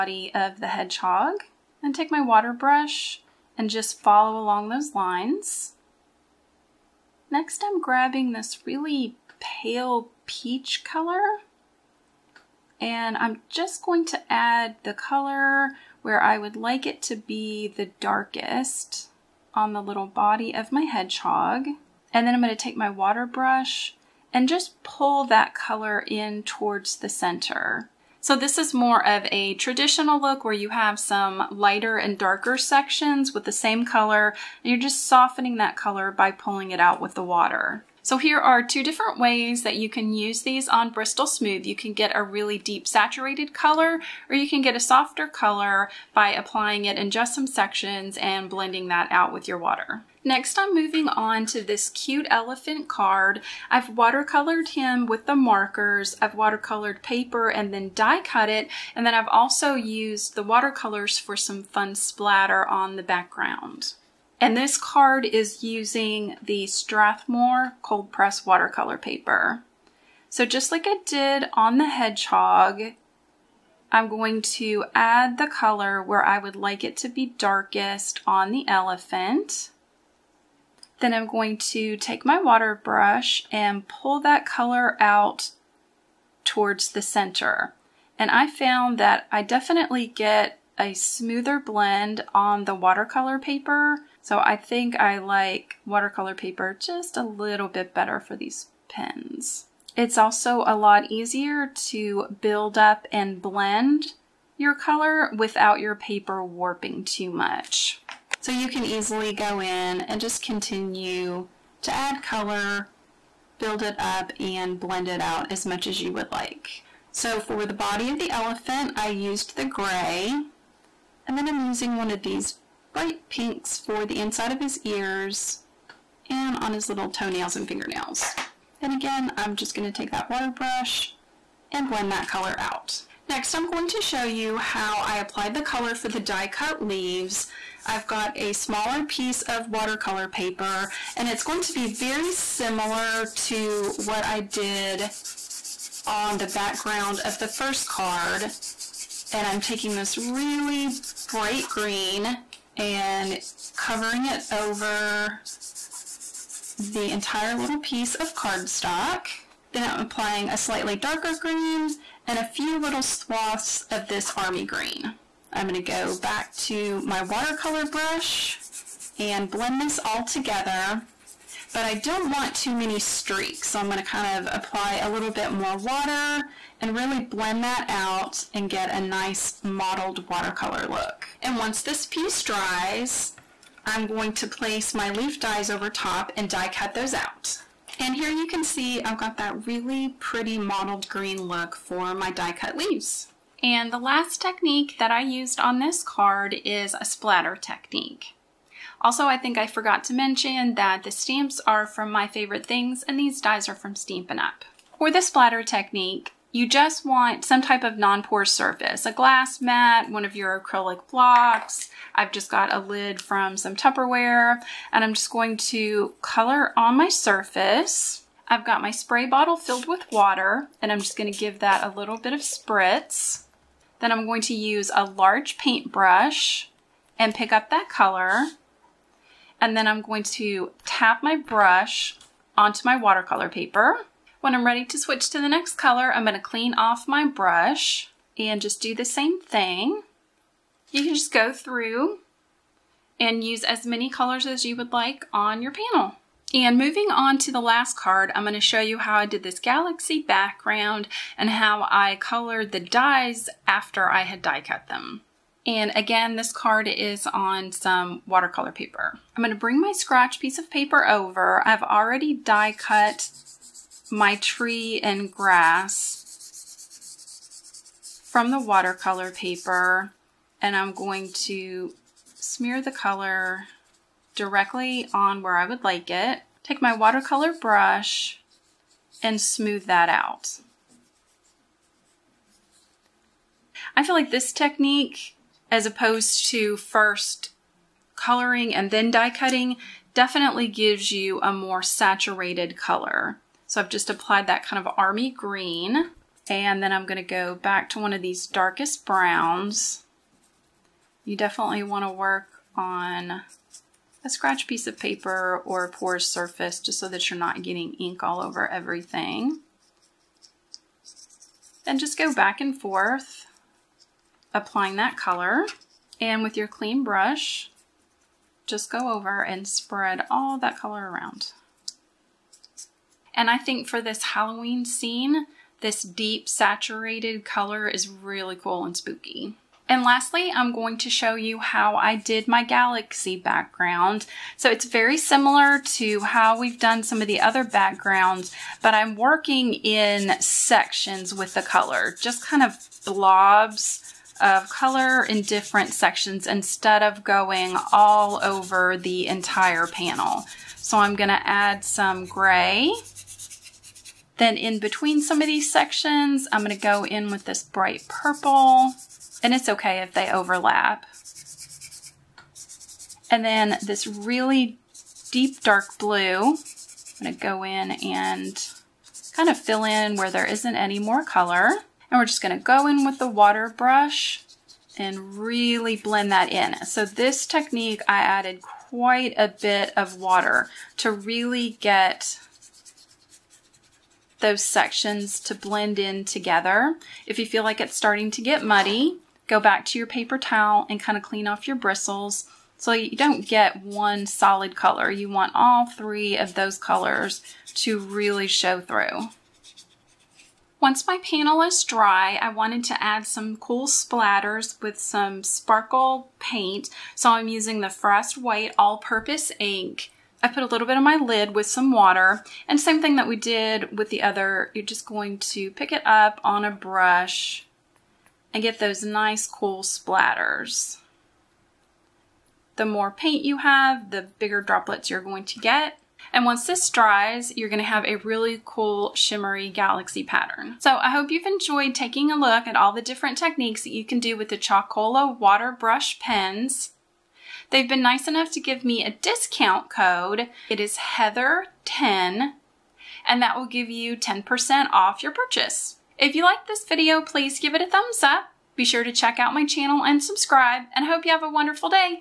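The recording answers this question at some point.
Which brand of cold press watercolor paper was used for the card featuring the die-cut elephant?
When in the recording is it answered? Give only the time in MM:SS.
01:06.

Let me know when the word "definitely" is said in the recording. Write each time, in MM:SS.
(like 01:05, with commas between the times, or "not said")
01:29, 04:50, 05:01.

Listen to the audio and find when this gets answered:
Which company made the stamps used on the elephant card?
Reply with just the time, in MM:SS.
03:22.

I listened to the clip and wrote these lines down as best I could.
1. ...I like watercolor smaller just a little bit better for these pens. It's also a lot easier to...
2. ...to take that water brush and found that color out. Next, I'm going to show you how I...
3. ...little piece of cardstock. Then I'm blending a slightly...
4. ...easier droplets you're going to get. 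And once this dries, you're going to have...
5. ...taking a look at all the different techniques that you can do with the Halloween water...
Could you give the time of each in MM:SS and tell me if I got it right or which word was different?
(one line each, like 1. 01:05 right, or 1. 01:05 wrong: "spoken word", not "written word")
1. 01:34 wrong: "paper", not "smaller"
2. 02:09 wrong: "blend", not "found"
3. 02:37 wrong: "applying", not "blending"
4. 07:04 wrong: "bigger", not "easier"
5. 07:11 wrong: "Chalkola", not "Halloween".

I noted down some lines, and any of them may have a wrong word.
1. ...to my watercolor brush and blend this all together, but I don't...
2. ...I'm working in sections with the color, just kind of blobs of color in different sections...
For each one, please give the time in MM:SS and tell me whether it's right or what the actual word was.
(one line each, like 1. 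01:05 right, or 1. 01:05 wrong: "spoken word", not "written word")
1. 02:46 right
2. 05:38 right.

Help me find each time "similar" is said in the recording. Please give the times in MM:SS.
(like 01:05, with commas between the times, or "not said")
02:22, 05:35.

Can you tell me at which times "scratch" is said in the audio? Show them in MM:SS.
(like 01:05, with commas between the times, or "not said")
04:19, 05:04.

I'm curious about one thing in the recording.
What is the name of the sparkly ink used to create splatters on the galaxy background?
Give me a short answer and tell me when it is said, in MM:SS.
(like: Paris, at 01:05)
Frost White All-Purpose Ink, at 06:47.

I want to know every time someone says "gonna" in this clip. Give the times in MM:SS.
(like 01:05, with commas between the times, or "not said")
02:45, 02:53, 03:41, 03:56, 05:51.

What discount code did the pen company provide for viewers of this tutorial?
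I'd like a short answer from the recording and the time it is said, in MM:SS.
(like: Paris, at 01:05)
Heather10, at 07:20.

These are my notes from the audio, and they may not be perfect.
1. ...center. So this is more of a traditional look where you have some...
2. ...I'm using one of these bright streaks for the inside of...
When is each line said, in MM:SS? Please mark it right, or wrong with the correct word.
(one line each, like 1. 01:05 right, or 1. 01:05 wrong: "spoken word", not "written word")
1. 00:27 right
2. 02:01 wrong: "pinks", not "streaks".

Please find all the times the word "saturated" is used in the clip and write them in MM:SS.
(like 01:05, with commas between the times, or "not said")
00:42, 04:51, 05:26.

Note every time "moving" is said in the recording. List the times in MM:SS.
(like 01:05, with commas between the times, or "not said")
00:50, 04:06.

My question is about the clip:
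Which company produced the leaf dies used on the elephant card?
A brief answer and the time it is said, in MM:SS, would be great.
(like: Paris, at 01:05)
Stampin' Up, at 03:23.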